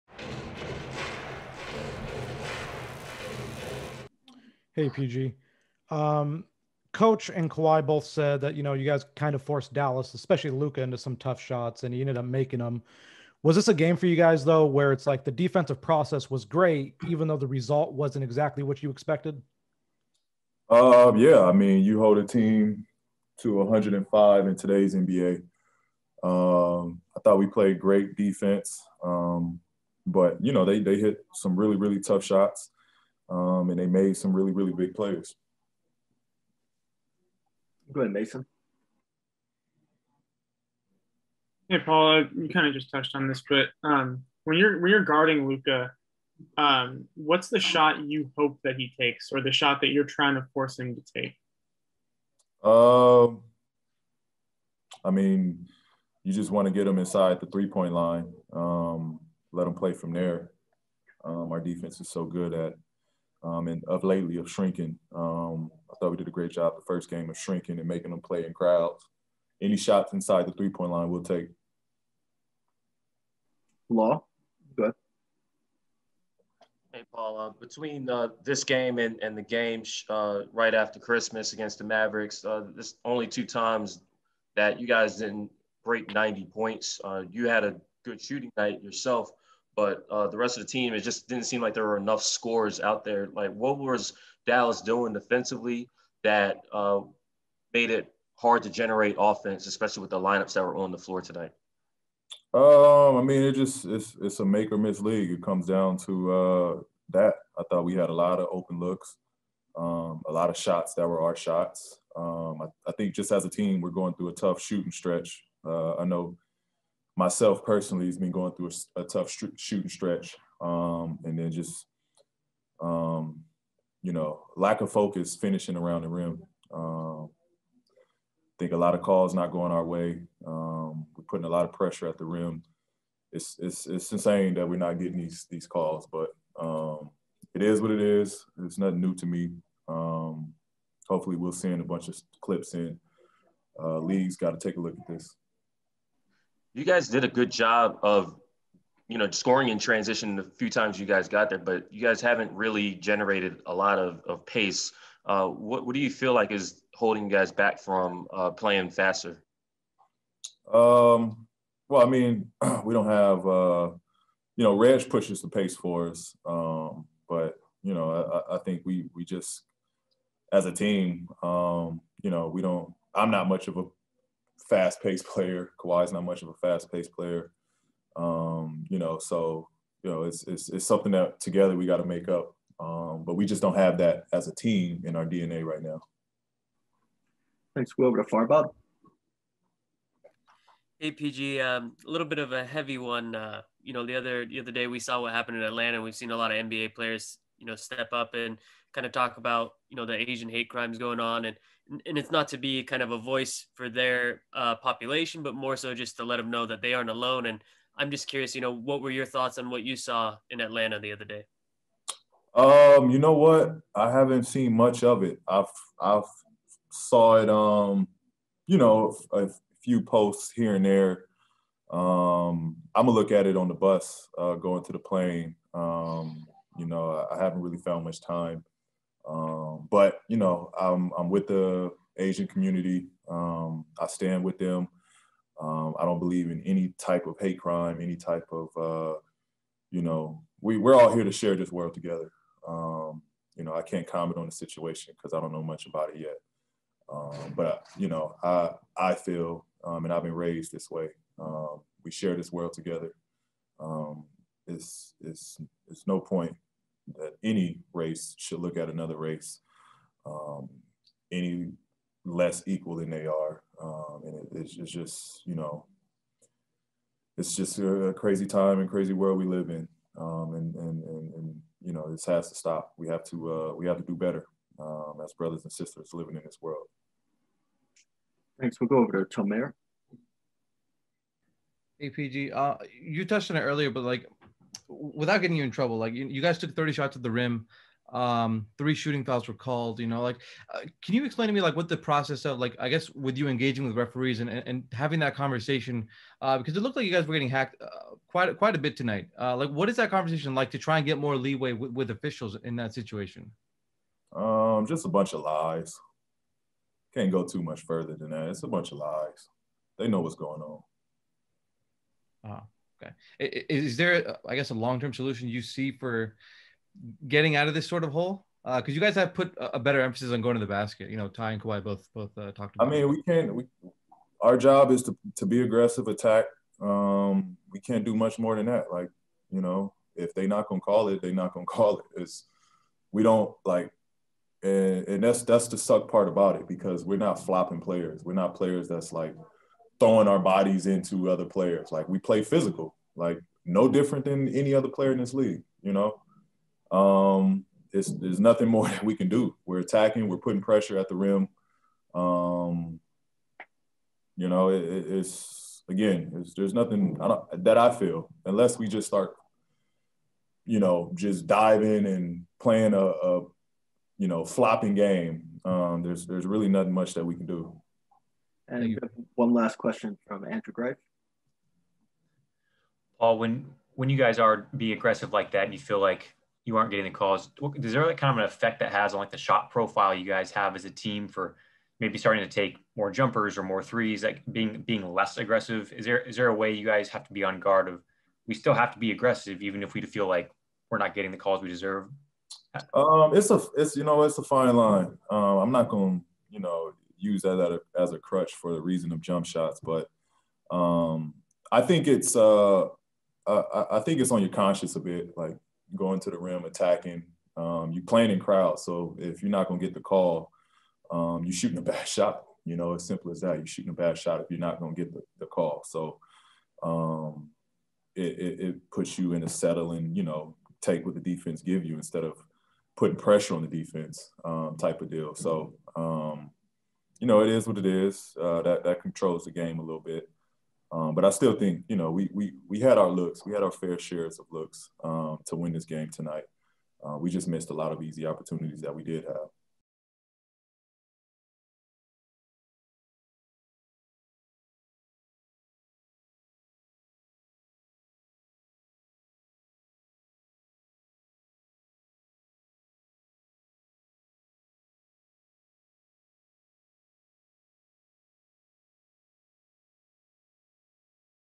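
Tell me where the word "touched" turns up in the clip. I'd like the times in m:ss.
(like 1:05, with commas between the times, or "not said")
0:42, 4:43.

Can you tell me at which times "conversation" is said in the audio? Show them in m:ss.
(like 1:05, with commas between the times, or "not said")
4:55, 5:00.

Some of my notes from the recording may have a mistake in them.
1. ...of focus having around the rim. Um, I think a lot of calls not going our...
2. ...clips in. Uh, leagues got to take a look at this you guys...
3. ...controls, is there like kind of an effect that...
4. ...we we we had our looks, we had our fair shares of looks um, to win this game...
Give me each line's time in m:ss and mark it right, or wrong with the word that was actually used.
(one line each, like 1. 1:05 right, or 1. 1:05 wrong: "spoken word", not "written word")
1. 2:04 wrong: "finishing", not "having"
2. 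2:22 right
3. 6:17 wrong: "calls", not "controls"
4. 7:12 right.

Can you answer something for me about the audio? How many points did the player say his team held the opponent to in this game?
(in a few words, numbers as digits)
105.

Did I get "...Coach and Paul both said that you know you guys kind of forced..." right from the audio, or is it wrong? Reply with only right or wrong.
wrong.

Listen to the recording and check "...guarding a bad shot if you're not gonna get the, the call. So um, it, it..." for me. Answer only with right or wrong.
wrong.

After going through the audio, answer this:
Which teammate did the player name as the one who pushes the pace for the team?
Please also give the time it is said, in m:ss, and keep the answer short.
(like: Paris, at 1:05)
Reg, at 2:44.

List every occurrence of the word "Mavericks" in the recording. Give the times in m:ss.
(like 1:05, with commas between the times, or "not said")
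1:21.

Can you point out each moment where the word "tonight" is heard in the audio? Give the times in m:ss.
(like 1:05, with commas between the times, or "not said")
1:41, 4:58, 7:16.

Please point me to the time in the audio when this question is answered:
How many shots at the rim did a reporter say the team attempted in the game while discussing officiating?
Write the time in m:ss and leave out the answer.
4:46.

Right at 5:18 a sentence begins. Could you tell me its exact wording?
Because uh, you guys have put a better emphasis on going to the basket.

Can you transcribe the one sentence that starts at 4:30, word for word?
Um, and, and, and, and, you know, this has to stop.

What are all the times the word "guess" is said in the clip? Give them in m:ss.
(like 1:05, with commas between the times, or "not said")
4:52, 5:14.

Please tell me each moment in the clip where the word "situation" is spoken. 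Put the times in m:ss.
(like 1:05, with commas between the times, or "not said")
4:04, 5:02.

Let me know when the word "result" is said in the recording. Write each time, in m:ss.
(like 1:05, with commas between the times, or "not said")
0:17.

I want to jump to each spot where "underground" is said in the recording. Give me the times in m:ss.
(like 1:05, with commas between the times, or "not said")
not said.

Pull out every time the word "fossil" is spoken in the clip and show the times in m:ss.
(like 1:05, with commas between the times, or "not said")
not said.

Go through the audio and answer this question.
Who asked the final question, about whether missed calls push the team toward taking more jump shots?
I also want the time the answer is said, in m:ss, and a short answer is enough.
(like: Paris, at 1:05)
Andrew Greif, at 6:10.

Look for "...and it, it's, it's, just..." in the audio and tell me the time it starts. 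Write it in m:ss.
4:24.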